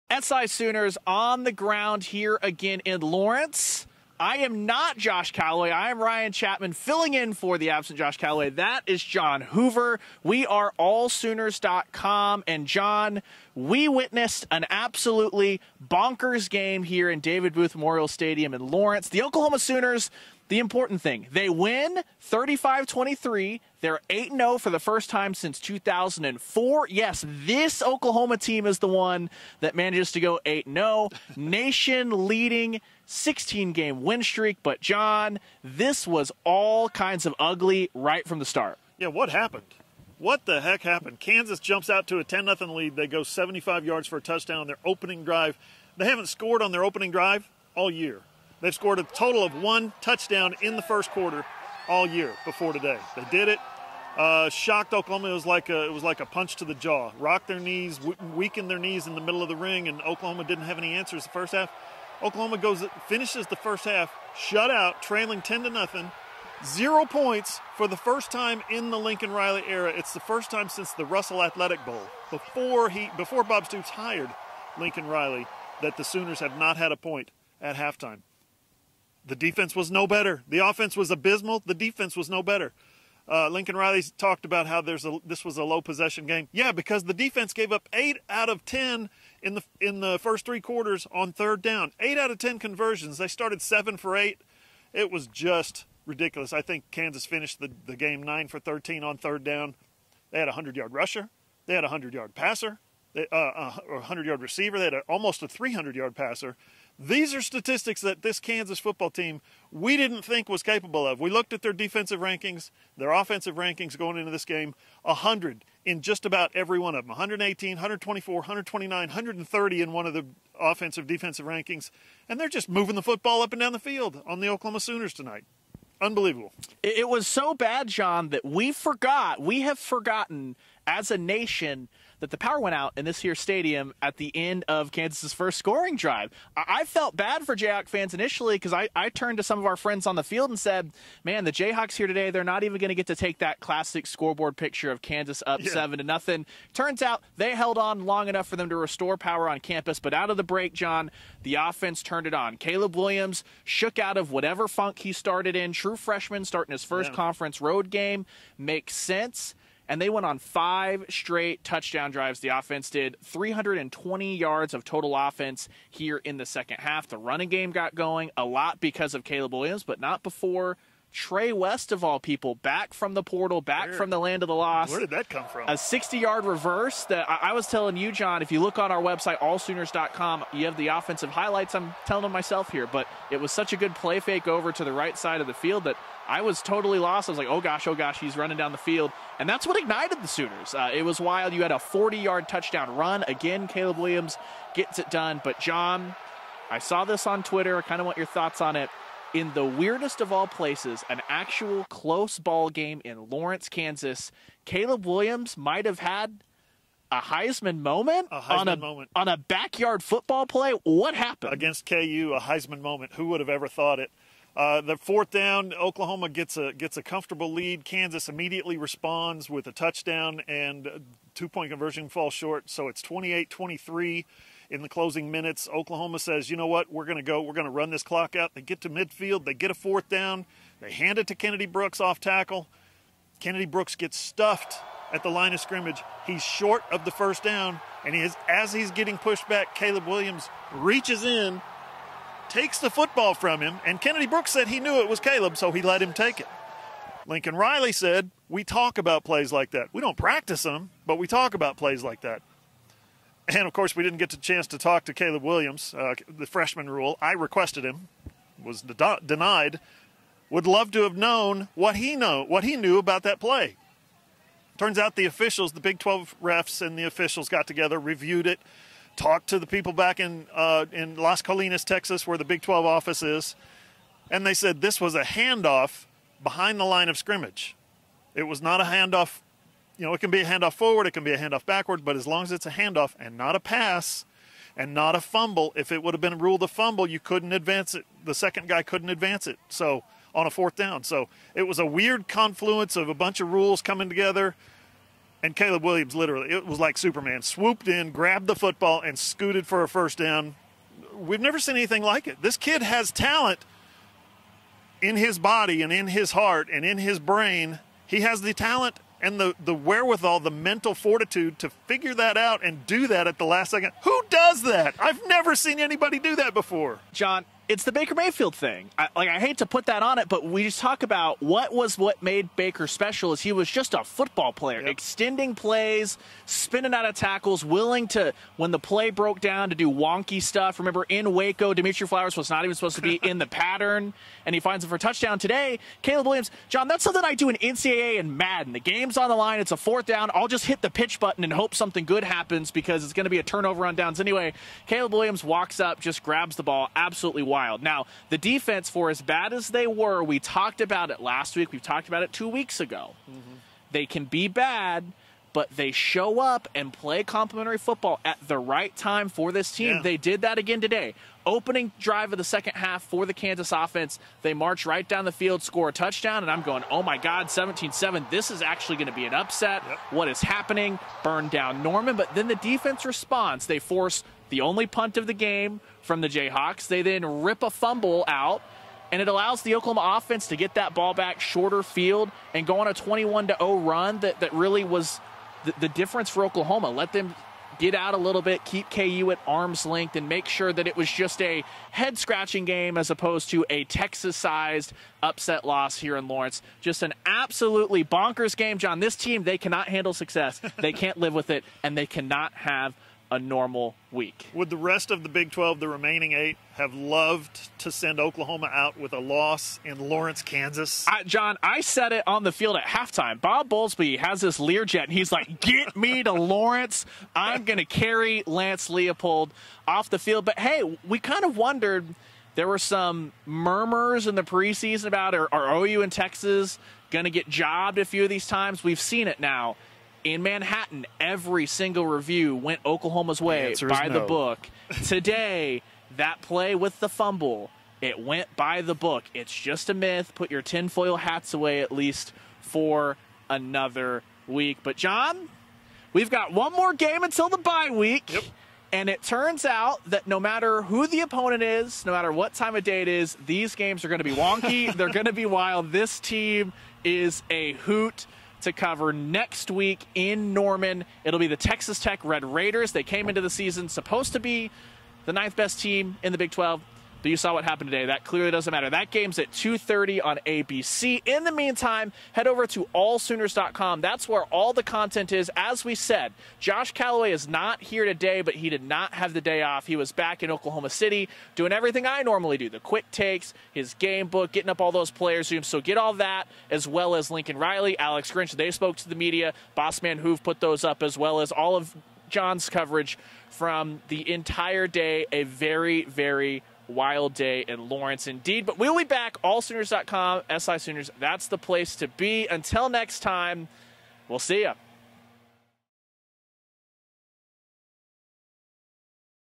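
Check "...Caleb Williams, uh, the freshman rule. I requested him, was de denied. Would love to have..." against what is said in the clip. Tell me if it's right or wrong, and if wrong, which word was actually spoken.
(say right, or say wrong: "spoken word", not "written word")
right.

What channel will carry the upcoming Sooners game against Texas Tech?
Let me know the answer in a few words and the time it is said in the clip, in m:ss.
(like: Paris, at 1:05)
ABC, at 7:50.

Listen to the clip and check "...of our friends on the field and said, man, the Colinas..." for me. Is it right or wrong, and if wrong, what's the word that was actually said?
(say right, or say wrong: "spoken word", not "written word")
wrong: "Jayhawks", not "Colinas".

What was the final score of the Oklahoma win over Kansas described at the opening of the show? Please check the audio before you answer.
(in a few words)
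35-23.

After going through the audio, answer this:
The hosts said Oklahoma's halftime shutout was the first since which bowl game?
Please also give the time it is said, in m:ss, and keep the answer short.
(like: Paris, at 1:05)
Russell Athletic Bowl, at 1:11.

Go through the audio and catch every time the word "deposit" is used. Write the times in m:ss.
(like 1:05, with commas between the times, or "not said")
not said.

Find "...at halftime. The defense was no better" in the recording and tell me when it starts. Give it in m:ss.
1:17.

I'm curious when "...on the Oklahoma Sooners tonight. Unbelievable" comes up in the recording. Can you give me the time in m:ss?
2:04.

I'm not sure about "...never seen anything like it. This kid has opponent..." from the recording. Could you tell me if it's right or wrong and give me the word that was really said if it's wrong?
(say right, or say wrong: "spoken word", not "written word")
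wrong: "talent", not "opponent".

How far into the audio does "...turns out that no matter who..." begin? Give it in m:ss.
7:29.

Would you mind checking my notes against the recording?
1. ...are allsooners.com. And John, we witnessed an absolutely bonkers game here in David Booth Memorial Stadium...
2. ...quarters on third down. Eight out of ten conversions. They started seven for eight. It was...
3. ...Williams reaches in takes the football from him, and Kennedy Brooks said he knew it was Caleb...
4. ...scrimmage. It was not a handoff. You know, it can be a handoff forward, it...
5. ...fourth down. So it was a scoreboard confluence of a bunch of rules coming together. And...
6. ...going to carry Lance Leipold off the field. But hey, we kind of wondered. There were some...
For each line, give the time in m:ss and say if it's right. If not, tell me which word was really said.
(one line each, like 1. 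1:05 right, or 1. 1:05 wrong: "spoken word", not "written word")
1. 0:10 right
2. 1:30 right
3. 4:00 right
4. 4:37 right
5. 4:50 wrong: "weird", not "scoreboard"
6. 6:57 right.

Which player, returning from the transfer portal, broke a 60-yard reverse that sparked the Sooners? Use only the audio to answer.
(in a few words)
Trey West.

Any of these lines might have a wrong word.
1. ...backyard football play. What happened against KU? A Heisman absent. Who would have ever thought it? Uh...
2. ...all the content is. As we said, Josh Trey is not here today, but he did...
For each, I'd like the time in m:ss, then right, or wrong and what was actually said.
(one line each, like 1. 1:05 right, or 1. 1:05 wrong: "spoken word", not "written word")
1. 3:29 wrong: "moment", not "absent"
2. 7:54 wrong: "Callaway", not "Trey".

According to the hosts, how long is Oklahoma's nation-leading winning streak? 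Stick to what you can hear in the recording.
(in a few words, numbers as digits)
16 games.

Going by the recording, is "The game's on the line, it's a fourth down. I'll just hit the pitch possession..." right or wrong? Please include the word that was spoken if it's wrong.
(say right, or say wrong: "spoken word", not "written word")
wrong: "button", not "possession".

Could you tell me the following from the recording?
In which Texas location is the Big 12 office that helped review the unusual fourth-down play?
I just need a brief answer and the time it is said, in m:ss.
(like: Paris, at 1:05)
Las Colinas, at 4:31.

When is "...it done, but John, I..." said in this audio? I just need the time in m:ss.
3:14.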